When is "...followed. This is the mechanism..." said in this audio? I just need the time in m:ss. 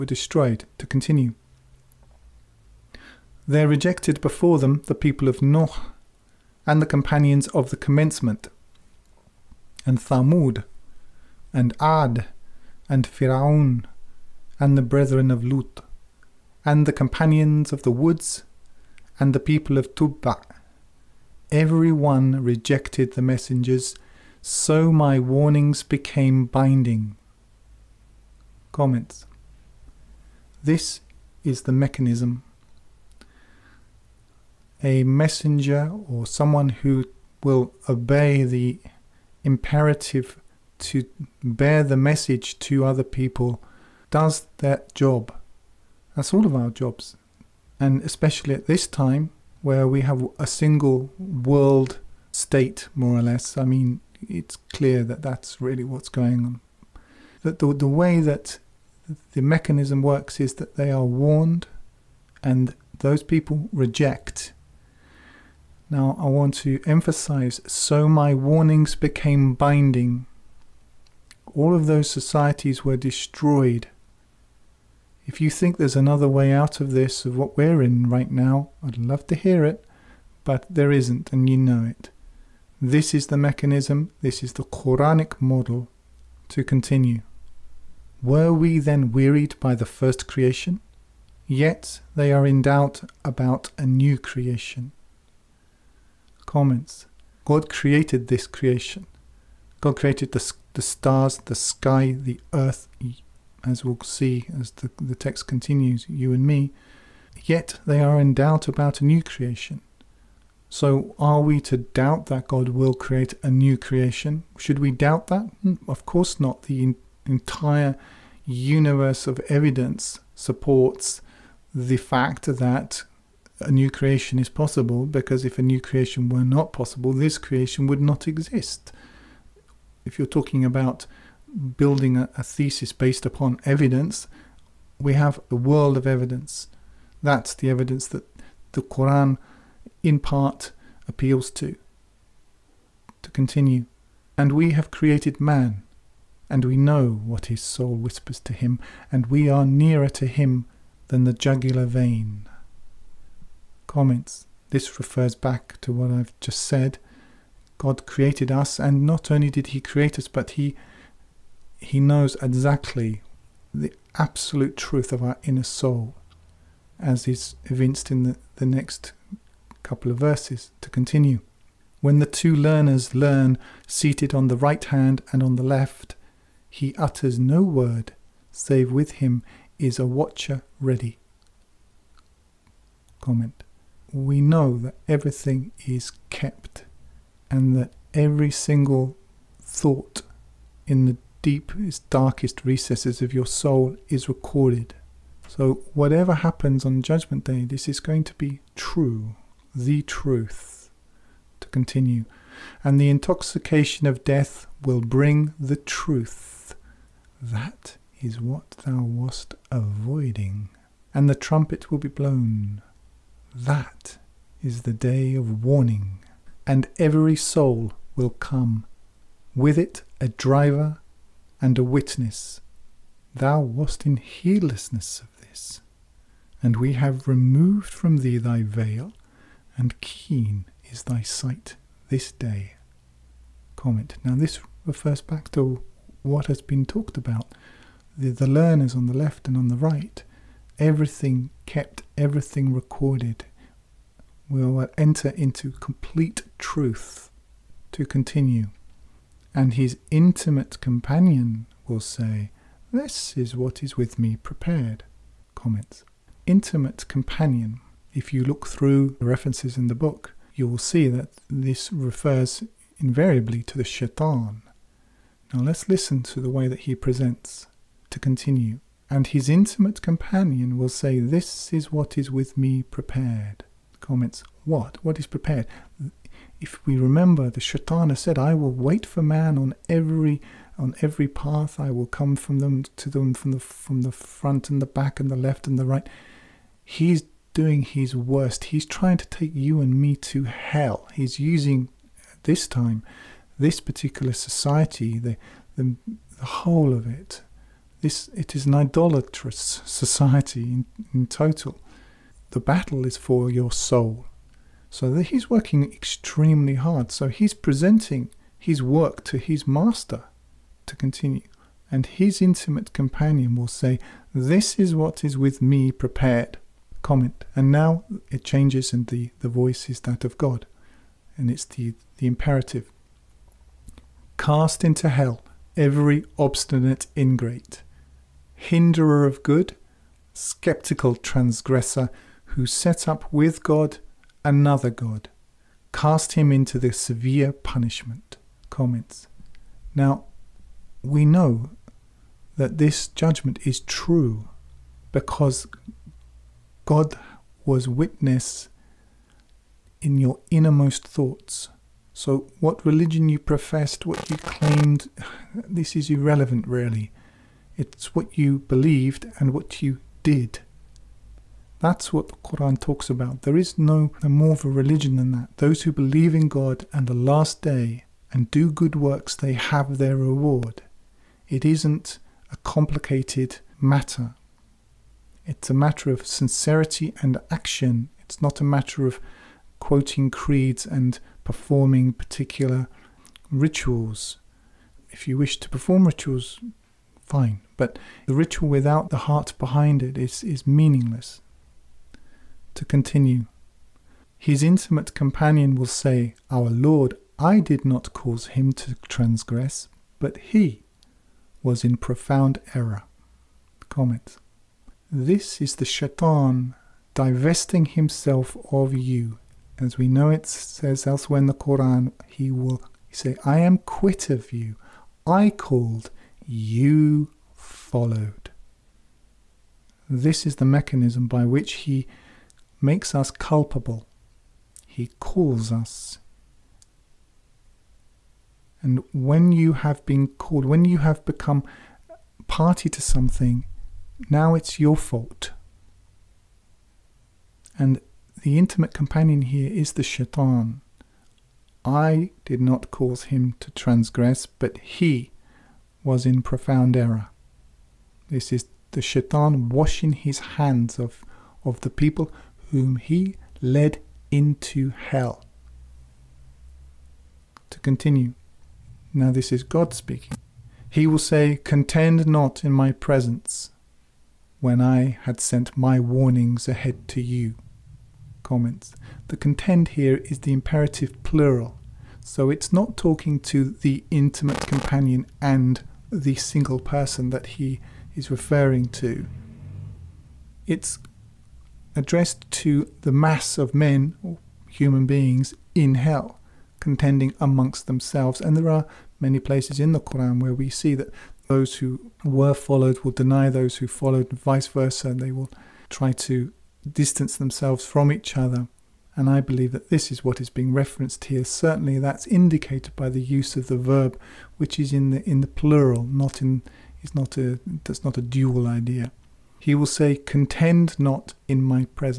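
6:57.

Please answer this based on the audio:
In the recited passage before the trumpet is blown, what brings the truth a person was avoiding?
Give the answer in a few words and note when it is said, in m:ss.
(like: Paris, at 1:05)
the intoxication of death, at 3:22.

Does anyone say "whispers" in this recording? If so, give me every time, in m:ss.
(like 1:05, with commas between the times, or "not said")
2:27.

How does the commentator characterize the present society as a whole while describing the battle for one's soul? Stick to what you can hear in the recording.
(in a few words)
idolatrous.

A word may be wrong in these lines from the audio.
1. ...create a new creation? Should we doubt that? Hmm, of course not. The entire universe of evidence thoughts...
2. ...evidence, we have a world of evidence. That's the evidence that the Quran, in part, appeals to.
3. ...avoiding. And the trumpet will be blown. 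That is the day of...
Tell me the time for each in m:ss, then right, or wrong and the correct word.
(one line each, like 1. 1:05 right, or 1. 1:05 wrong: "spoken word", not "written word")
1. 1:52 wrong: "supports", not "thoughts"
2. 2:13 right
3. 3:29 right.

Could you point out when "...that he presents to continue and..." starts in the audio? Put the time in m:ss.
4:26.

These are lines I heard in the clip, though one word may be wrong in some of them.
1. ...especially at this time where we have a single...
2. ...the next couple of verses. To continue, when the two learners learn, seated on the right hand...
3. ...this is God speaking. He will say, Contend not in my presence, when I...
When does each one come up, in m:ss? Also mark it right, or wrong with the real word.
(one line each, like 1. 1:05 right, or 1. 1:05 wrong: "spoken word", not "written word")
1. 0:48 right
2. 2:48 right
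3. 7:39 right.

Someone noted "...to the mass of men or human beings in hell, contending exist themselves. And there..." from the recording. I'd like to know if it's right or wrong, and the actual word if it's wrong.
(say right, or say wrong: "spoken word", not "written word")
wrong: "amongst", not "exist".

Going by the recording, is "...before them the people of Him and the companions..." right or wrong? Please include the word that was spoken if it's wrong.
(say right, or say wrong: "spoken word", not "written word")
wrong: "Noh", not "Him".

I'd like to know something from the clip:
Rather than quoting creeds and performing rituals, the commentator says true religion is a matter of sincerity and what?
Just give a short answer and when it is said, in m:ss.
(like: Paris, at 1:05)
action, at 6:17.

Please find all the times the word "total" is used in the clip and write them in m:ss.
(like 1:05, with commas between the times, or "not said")
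5:01.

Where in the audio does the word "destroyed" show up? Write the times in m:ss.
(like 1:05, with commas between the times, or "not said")
0:00, 1:12.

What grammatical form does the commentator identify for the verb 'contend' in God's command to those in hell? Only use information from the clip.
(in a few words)
imperative plural.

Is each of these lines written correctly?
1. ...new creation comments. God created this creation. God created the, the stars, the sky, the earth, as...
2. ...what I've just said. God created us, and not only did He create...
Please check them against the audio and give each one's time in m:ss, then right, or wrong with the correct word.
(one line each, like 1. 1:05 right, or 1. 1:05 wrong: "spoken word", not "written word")
1. 1:33 right
2. 2:35 right.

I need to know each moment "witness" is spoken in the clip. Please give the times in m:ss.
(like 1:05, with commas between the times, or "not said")
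3:41, 5:47.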